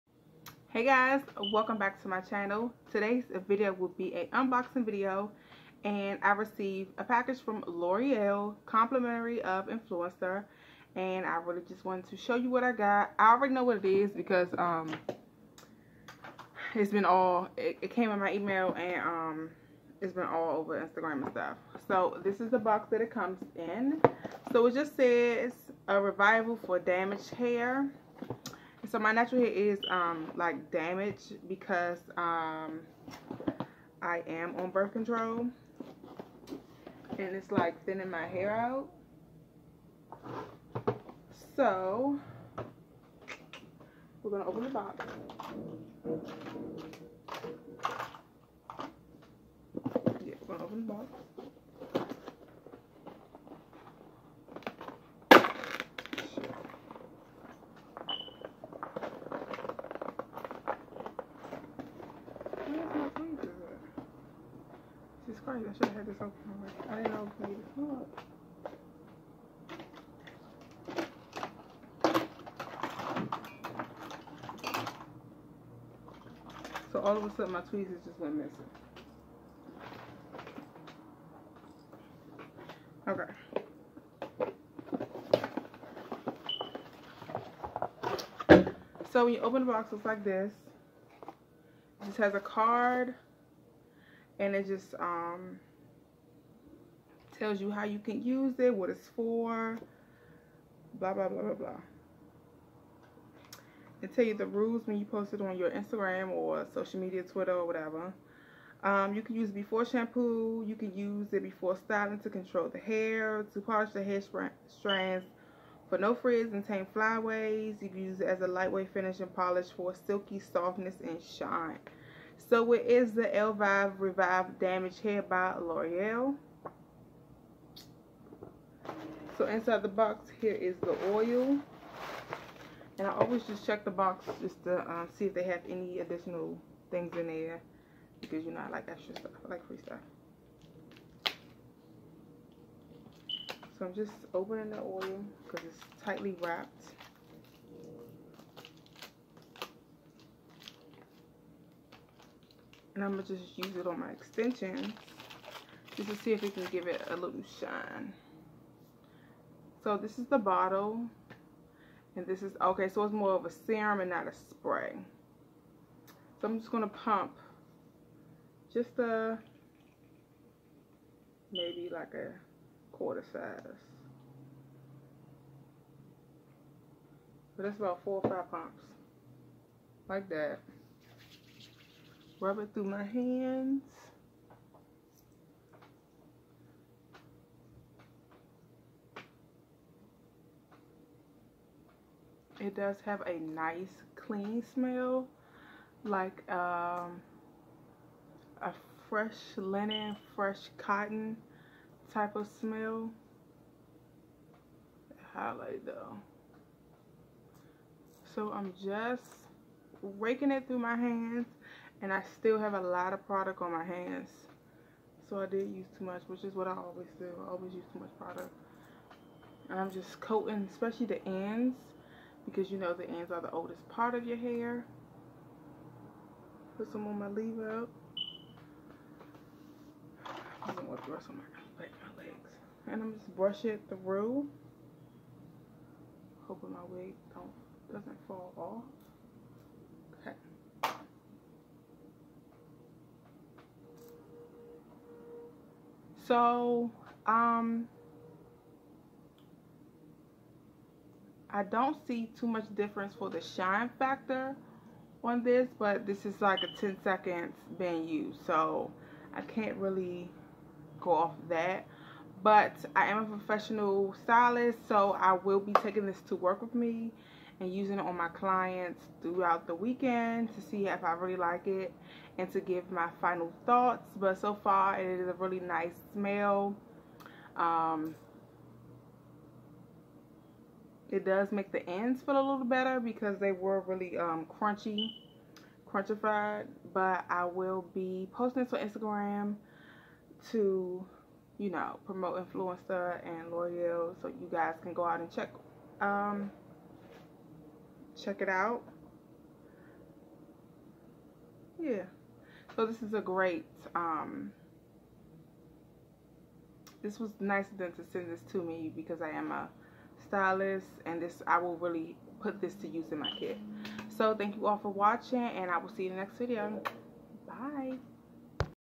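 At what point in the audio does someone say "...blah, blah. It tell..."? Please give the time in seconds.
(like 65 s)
101 s.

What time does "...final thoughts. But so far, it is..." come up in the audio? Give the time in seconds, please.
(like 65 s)
273 s.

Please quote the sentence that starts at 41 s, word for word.
So we're gonna open the box.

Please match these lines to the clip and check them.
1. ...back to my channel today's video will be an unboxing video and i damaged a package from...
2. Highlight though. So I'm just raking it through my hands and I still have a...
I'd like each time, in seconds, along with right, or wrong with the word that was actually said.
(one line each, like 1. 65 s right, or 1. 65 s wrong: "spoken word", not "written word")
1. 1 s wrong: "received", not "damaged"
2. 205 s right.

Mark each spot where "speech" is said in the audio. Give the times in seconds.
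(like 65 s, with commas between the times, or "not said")
not said.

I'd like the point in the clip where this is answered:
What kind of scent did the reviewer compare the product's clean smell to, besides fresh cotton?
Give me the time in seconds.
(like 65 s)
198 s.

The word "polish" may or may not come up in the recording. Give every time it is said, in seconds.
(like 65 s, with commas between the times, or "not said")
113 s, 119 s.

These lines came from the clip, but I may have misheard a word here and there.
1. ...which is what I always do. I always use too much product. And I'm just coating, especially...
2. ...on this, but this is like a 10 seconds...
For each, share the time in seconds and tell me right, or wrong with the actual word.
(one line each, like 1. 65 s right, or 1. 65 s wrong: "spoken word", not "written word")
1. 216 s right
2. 255 s right.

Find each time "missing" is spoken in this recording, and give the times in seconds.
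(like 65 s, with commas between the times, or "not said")
78 s.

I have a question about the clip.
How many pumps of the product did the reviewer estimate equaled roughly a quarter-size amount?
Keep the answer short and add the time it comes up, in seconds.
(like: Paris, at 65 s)
four or five, at 178 s.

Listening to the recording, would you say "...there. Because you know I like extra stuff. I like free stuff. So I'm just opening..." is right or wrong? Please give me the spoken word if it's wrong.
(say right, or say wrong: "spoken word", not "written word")
right.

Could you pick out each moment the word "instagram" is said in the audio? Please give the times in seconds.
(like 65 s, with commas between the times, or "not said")
20 s, 105 s, 288 s.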